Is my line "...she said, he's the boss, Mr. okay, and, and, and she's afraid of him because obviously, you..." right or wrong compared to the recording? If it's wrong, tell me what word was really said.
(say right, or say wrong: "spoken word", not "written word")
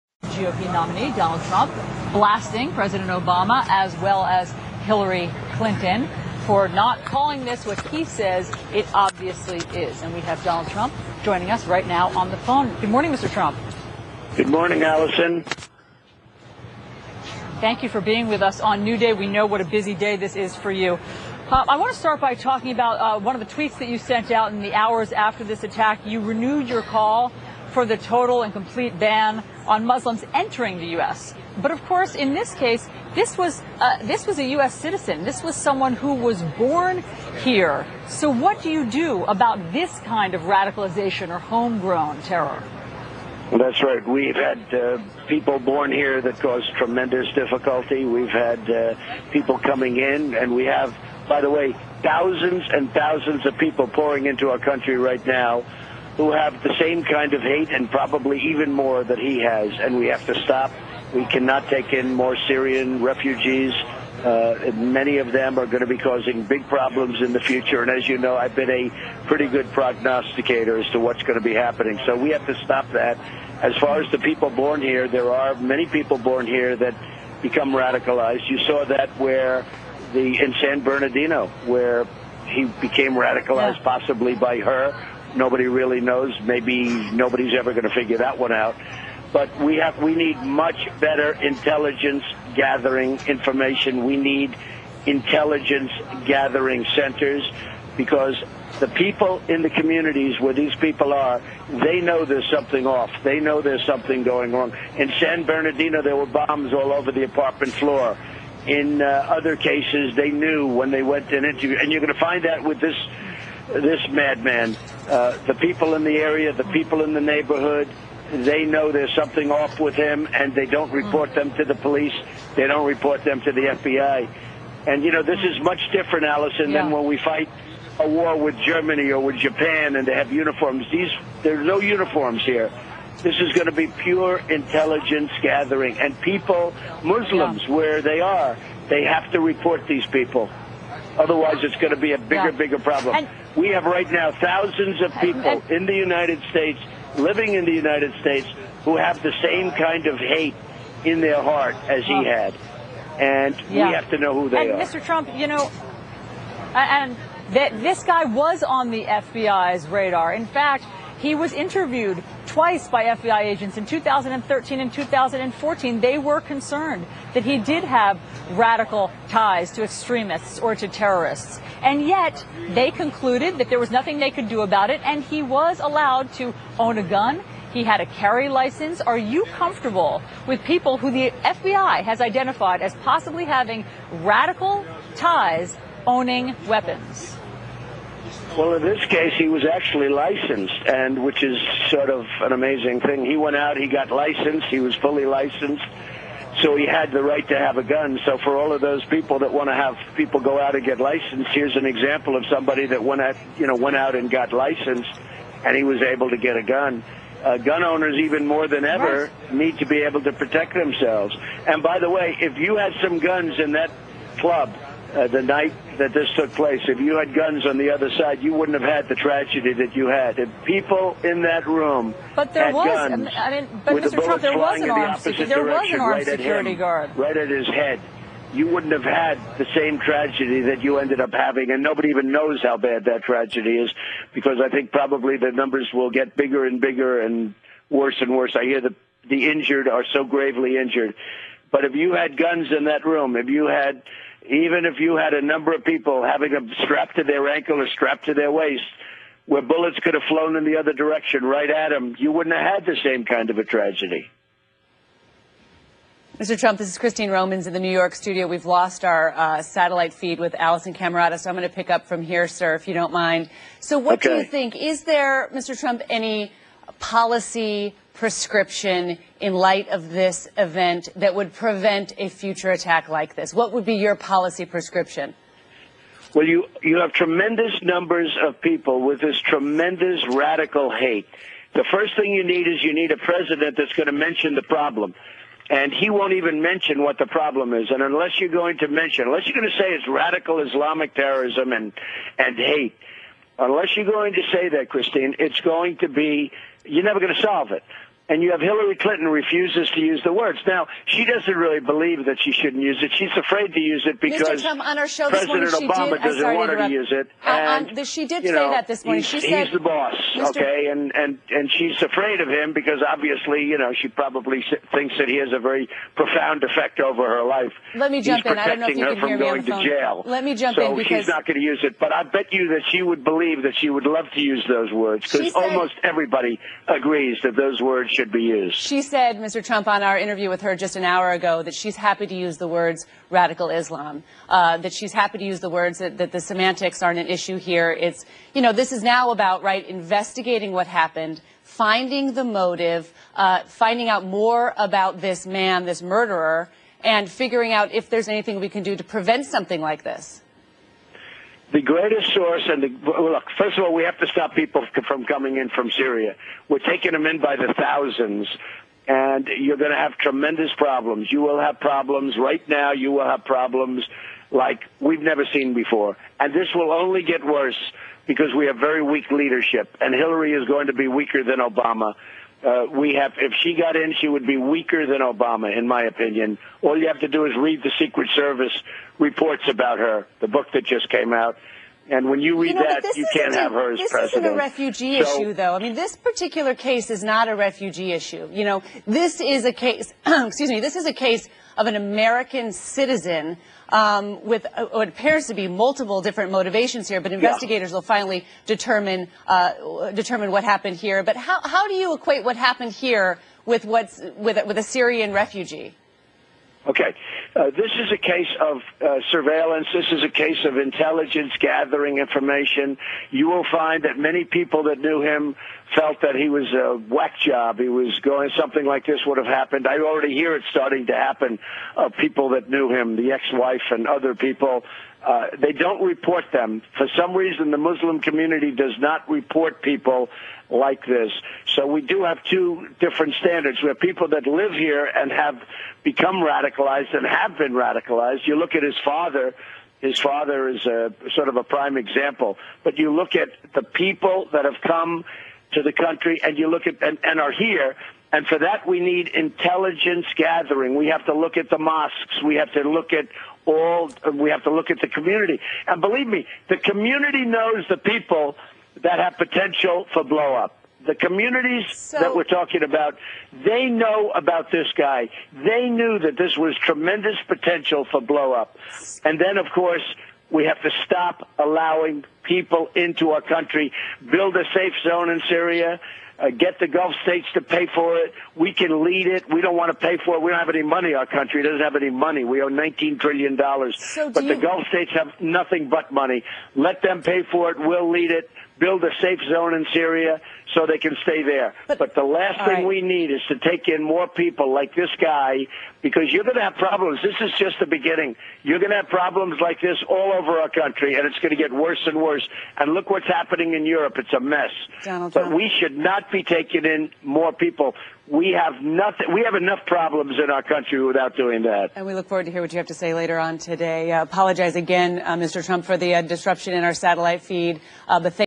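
right.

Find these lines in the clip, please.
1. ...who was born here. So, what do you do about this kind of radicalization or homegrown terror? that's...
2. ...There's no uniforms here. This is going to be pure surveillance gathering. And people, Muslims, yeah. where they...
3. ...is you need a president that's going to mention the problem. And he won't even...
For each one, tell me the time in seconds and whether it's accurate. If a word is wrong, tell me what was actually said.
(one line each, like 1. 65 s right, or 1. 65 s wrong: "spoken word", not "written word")
1. 35 s right
2. 131 s wrong: "intelligence", not "surveillance"
3. 282 s right.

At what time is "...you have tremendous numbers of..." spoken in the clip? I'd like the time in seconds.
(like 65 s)
276 s.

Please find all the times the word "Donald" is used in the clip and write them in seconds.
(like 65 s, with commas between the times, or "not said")
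1 s, 10 s, 505 s.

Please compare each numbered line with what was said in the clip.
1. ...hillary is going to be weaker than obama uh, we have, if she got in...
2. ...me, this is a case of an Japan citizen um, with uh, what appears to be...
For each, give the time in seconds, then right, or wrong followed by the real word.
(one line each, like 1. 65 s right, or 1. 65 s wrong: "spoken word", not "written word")
1. 370 s right
2. 390 s wrong: "American", not "Japan".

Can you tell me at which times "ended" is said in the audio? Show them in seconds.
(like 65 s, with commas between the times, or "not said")
230 s.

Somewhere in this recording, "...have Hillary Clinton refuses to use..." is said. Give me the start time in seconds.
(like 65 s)
298 s.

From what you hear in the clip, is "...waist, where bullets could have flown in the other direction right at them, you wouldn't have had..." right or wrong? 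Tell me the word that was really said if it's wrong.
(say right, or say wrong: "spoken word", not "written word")
right.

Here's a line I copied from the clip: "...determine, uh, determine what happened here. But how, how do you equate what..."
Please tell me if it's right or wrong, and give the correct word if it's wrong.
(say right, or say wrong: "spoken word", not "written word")
right.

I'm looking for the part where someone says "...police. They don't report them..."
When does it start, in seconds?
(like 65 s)
121 s.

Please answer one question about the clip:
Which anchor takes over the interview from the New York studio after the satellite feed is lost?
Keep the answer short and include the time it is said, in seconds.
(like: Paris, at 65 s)
Christine Romans, at 256 s.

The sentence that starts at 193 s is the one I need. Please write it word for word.
He went out, he got licensed, he was fully licensed, so he had the right to have a gun.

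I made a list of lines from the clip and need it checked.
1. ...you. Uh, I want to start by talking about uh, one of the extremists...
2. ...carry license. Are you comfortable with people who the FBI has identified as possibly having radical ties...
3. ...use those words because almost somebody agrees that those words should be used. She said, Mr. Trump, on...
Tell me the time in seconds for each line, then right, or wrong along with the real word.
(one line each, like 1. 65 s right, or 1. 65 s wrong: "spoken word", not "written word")
1. 20 s wrong: "tweets", not "extremists"
2. 178 s right
3. 324 s wrong: "everybody", not "somebody".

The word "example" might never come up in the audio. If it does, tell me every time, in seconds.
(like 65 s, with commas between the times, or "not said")
201 s, 441 s.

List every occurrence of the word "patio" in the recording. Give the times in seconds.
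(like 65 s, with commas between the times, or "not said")
not said.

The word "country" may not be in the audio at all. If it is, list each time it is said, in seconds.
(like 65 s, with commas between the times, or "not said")
54 s, 445 s, 473 s, 481 s, 500 s, 510 s.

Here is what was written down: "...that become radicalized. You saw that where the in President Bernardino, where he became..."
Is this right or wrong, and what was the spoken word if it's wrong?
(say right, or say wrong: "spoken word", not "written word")
wrong: "San", not "President".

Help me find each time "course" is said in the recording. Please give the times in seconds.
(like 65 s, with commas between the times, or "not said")
31 s, 469 s.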